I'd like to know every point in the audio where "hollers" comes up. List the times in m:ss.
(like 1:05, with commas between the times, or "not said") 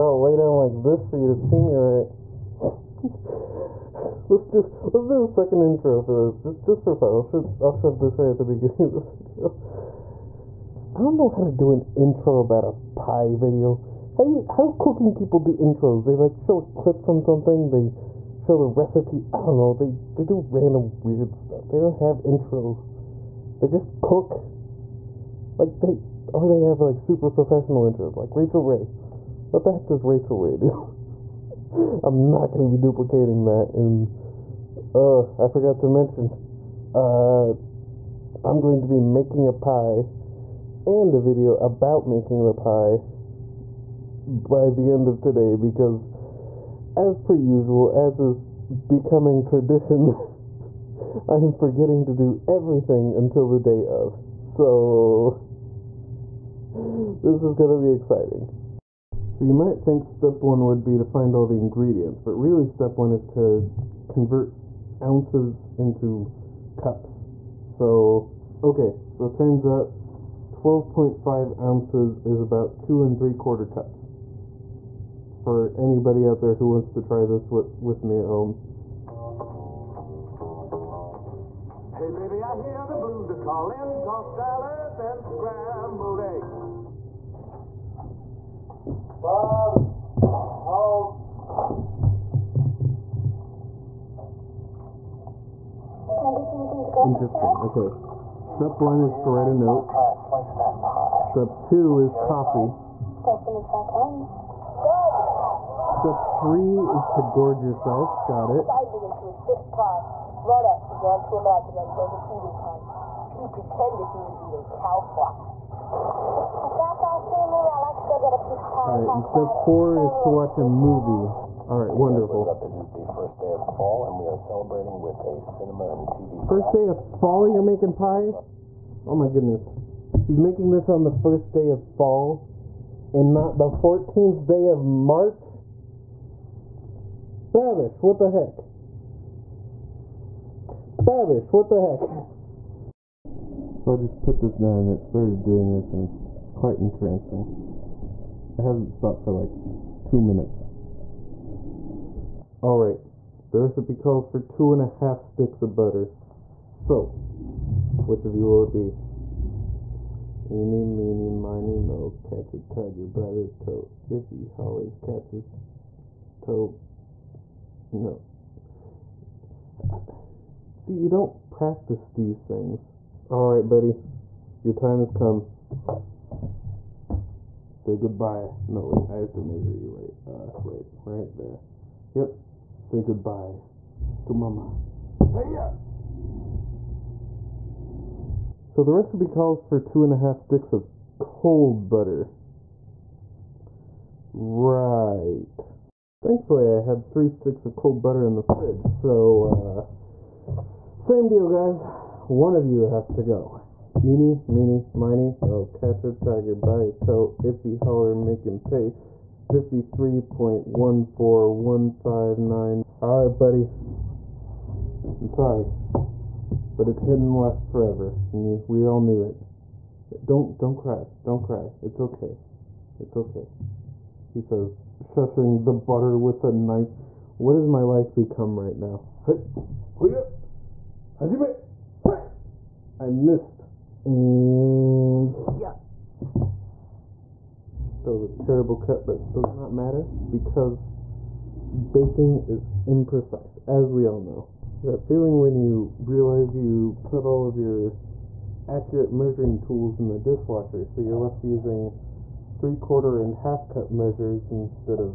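2:44, 3:27.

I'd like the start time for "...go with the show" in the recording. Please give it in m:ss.
1:36.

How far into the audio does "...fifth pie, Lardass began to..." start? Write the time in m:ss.
1:49.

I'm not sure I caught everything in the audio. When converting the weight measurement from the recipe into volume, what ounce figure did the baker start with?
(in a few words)
12.5 ounces.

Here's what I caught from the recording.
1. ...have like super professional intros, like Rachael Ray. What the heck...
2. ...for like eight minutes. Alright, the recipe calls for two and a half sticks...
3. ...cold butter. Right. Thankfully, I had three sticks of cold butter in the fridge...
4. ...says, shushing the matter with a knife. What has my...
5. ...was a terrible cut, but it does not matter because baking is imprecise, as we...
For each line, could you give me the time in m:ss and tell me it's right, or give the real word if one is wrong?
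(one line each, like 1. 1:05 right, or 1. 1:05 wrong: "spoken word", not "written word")
1. 0:26 right
2. 2:29 wrong: "two", not "eight"
3. 3:11 right
4. 3:44 wrong: "butter", not "matter"
5. 3:58 right.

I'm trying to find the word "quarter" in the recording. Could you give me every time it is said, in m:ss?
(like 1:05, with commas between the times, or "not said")
1:13, 4:12.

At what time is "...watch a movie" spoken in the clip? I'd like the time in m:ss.
2:00.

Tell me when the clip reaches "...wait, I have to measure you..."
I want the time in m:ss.
2:58.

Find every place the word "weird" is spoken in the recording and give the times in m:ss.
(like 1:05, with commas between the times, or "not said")
0:21.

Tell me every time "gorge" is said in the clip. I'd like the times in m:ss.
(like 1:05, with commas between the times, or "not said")
1:47.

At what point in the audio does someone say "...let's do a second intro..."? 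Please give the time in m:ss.
0:04.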